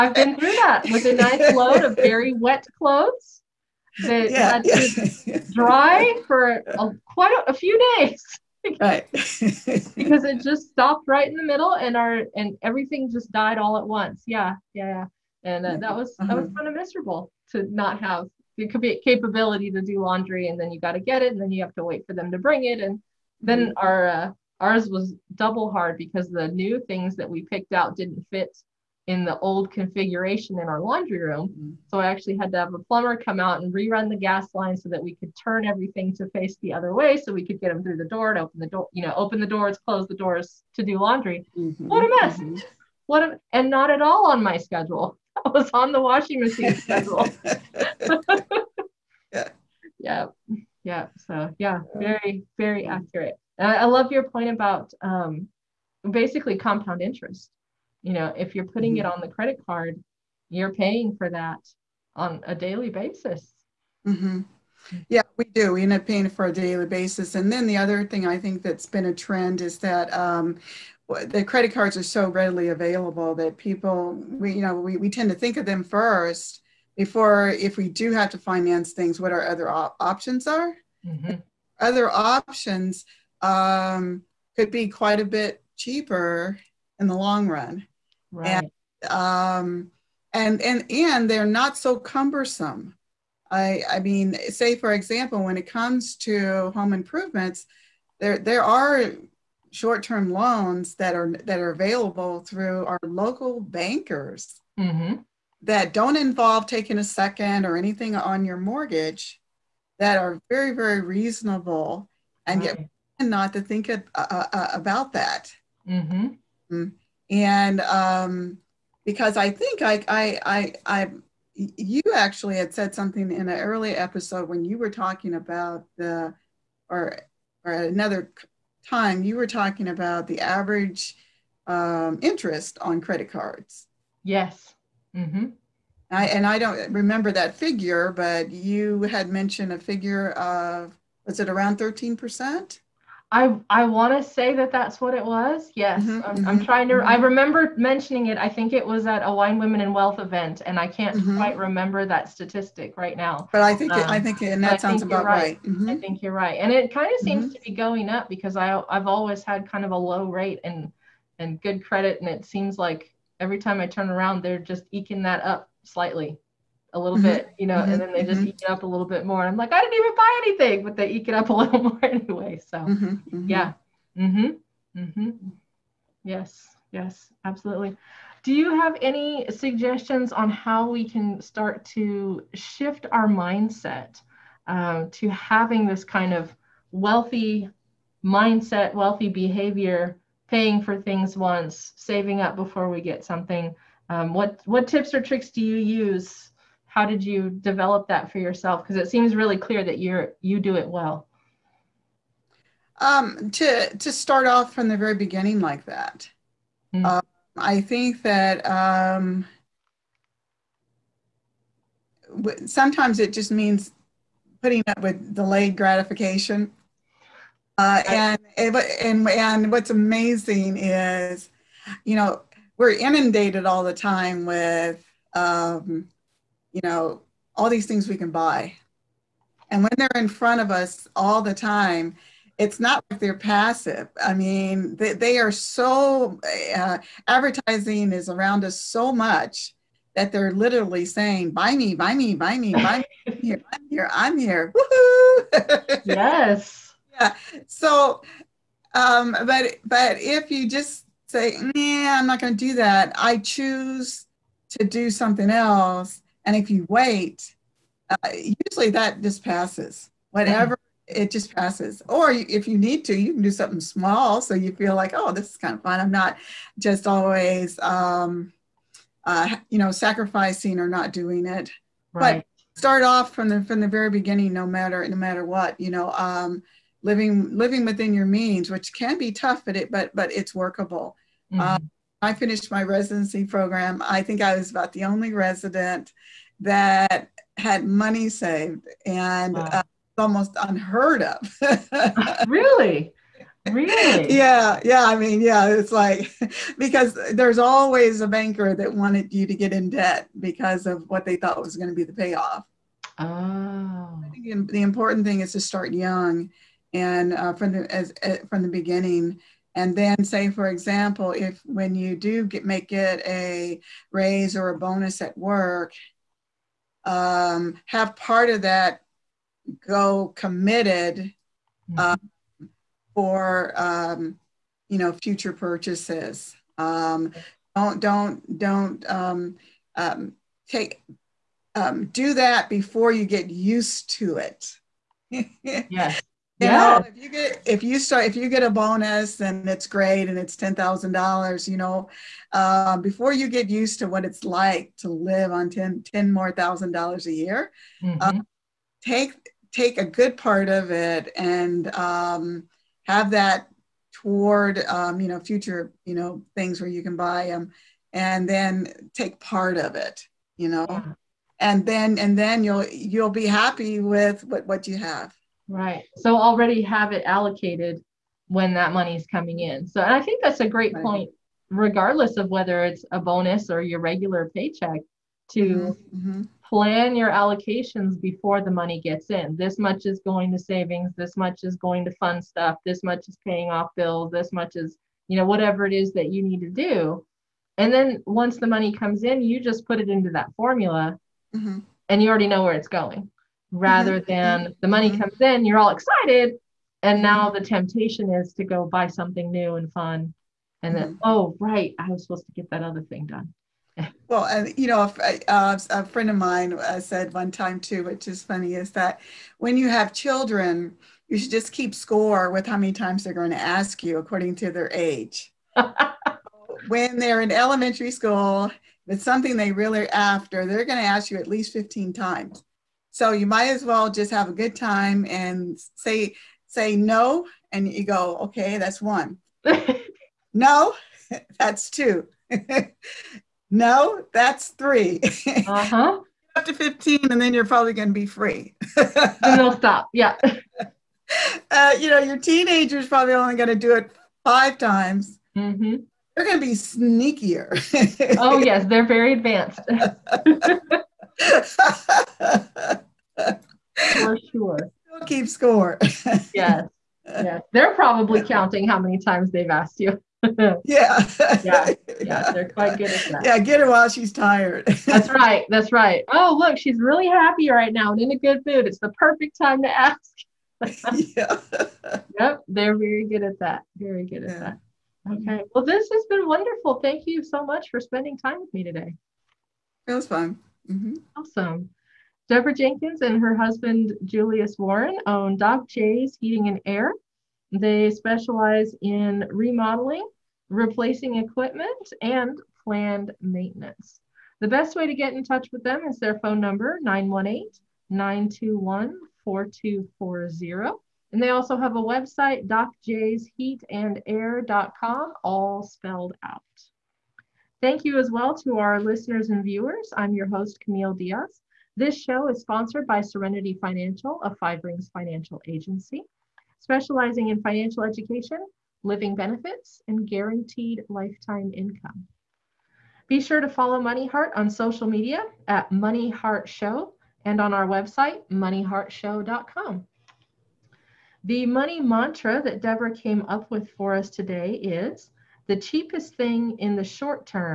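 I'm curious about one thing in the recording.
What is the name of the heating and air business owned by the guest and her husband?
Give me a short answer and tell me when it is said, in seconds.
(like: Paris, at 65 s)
Doc J's Heating and Air, at 485 s.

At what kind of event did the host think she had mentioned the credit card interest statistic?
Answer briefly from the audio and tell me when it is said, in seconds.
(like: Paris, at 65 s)
Wine Women and Wealth, at 149 s.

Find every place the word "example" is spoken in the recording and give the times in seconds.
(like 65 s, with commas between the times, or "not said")
94 s, 310 s.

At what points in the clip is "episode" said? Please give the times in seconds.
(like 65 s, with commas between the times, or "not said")
123 s.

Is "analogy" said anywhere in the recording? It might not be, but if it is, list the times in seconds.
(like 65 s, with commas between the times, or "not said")
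not said.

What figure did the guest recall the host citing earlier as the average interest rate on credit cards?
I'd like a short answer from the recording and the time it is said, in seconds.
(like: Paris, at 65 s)
13 percent, at 141 s.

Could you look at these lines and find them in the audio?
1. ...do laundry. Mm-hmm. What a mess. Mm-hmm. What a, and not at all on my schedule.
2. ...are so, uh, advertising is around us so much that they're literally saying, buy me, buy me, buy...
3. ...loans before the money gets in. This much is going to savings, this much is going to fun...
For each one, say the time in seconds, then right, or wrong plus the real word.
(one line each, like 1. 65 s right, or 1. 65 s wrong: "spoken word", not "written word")
1. 40 s right
2. 235 s right
3. 377 s wrong: "allocations", not "loans".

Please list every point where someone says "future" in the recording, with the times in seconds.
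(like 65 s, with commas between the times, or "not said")
325 s, 355 s.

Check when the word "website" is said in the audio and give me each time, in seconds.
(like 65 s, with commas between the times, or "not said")
502 s, 527 s.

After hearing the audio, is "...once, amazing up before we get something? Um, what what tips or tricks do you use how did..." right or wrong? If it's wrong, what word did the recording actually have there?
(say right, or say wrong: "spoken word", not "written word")
wrong: "saving", not "amazing".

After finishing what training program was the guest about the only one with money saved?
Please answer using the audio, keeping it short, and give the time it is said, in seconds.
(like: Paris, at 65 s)
residency program, at 282 s.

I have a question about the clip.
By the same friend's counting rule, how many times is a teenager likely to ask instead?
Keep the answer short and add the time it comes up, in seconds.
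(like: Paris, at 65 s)
5, at 444 s.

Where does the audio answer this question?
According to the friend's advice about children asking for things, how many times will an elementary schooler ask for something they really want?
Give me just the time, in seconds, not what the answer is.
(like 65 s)
421 s.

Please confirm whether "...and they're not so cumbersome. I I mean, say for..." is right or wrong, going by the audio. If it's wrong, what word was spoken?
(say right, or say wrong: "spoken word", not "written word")
right.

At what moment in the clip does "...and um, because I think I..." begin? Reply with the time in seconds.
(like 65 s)
117 s.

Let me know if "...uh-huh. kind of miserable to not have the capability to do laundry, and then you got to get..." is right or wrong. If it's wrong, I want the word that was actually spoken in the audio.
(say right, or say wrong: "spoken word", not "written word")
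right.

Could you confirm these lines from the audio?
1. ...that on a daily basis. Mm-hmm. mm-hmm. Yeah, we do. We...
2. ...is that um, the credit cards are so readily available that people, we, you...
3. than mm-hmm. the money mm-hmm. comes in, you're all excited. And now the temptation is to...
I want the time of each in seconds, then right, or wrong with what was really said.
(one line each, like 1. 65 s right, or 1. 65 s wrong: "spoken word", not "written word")
1. 61 s right
2. 69 s right
3. 394 s right.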